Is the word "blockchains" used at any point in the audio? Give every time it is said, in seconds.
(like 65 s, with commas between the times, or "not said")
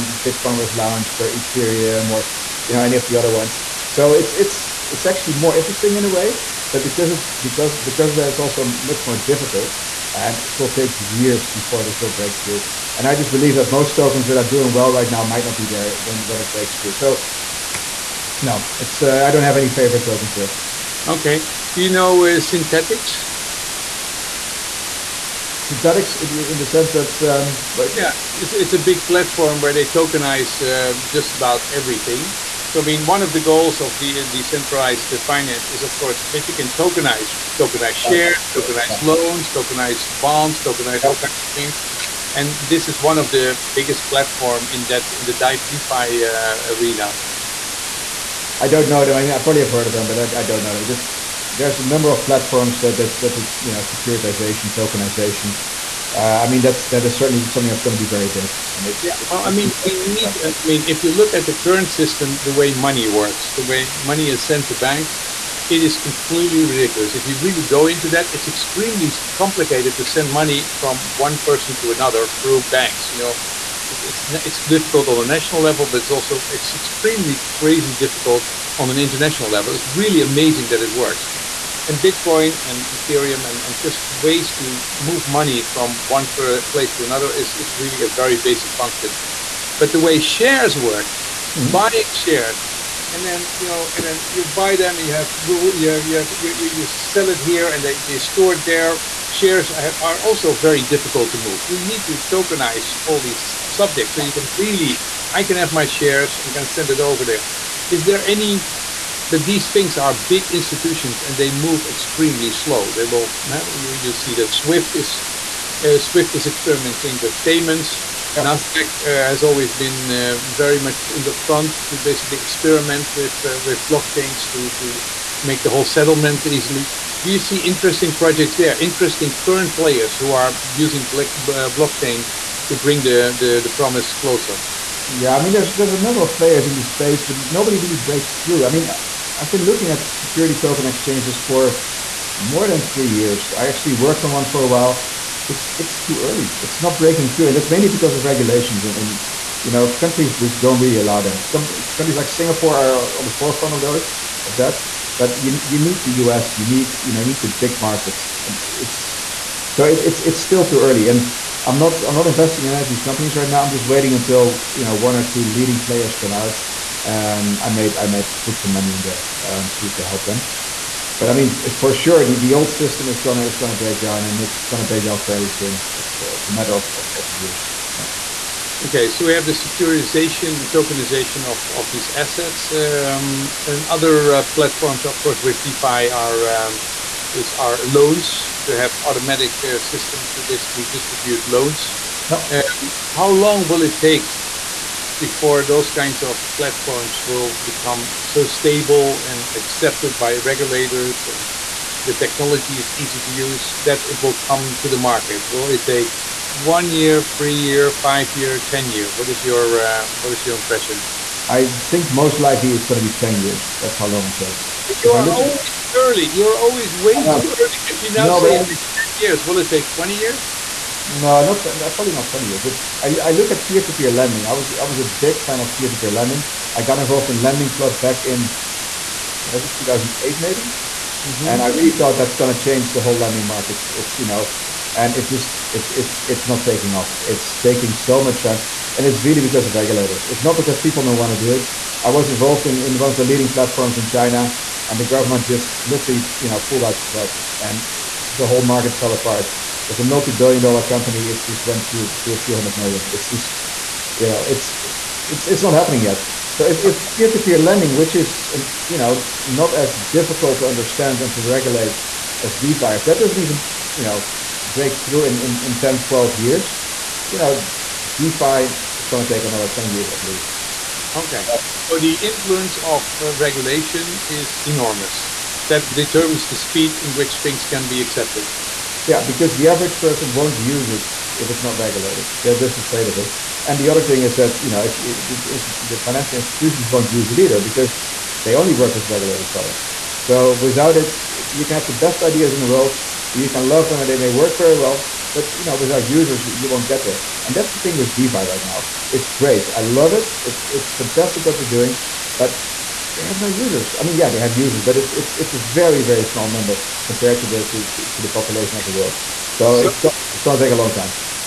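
123 s, 131 s.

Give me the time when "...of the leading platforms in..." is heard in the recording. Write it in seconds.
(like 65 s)
243 s.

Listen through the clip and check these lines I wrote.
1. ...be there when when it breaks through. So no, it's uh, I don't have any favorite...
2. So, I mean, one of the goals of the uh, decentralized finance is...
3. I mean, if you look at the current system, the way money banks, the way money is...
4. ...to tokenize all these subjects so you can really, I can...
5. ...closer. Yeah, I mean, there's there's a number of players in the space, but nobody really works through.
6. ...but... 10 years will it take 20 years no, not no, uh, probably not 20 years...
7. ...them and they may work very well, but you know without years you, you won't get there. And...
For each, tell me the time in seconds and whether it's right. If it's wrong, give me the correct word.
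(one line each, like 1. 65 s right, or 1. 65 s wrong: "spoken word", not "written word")
1. 15 s right
2. 32 s right
3. 60 s wrong: "works", not "banks"
4. 102 s right
5. 134 s wrong: "breaks", not "works"
6. 218 s right
7. 293 s wrong: "users", not "years".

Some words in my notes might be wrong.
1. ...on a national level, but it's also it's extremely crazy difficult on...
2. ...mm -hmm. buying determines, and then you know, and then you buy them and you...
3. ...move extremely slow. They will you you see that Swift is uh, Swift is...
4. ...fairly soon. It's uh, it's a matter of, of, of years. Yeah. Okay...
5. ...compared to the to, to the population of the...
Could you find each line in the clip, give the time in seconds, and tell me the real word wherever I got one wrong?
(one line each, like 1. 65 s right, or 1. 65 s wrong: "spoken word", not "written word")
1. 75 s right
2. 91 s wrong: "shares", not "determines"
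3. 111 s right
4. 175 s right
5. 307 s right.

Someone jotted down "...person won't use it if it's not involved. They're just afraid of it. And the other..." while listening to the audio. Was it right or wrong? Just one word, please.
wrong.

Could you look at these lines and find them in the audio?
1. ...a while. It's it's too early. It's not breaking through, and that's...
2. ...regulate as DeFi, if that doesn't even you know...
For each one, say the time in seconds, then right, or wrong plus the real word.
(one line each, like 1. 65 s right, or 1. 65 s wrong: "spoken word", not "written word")
1. 144 s right
2. 261 s right.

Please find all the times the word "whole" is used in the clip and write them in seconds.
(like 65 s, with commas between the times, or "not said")
125 s, 232 s, 248 s.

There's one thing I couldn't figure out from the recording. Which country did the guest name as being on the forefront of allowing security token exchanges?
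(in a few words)
Singapore.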